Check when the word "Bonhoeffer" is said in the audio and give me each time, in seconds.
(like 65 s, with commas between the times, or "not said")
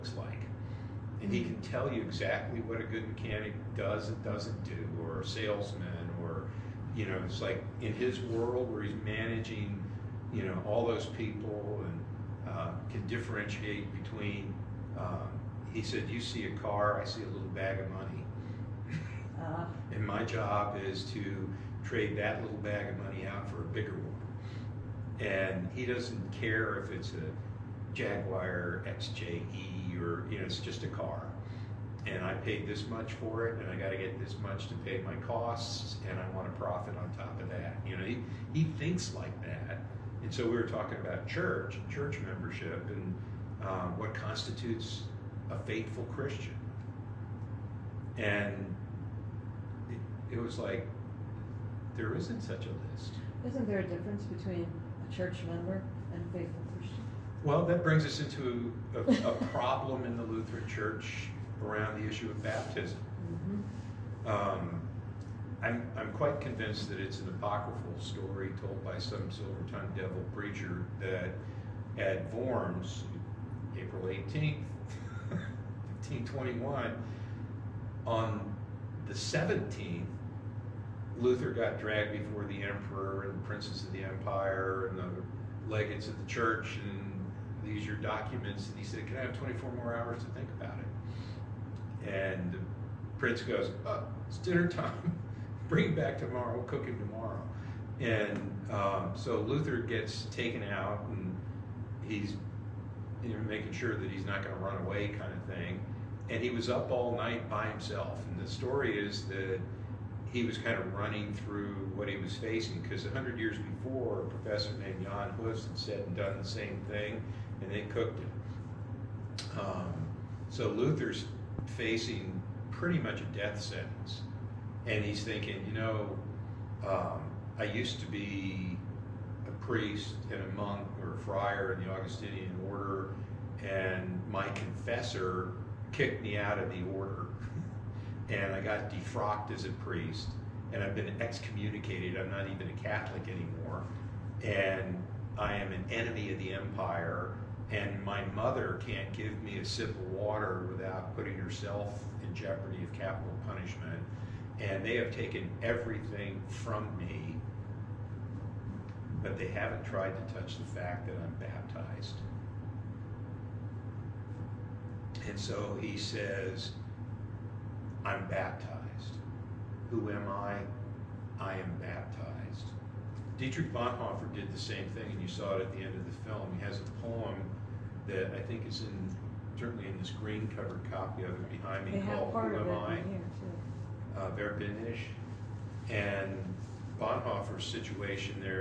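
173 s, 187 s.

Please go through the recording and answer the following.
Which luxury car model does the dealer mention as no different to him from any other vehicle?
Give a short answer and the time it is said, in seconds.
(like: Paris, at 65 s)
Jaguar XJE, at 27 s.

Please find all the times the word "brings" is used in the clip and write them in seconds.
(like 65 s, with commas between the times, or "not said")
57 s, 95 s.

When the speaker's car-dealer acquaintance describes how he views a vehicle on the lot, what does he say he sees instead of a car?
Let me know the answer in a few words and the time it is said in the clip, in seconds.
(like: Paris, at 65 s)
a little bag of money, at 17 s.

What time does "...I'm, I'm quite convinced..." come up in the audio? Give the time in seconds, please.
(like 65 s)
65 s.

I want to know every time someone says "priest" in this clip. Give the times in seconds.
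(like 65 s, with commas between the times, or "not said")
129 s, 139 s.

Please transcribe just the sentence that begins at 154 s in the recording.
And they have taken everything from me, but they haven't tried to touch the fact that I'm baptized.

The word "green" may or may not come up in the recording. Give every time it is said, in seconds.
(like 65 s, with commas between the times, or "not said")
180 s.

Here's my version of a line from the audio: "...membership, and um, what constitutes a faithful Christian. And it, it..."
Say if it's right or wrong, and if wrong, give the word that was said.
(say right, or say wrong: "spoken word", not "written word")
right.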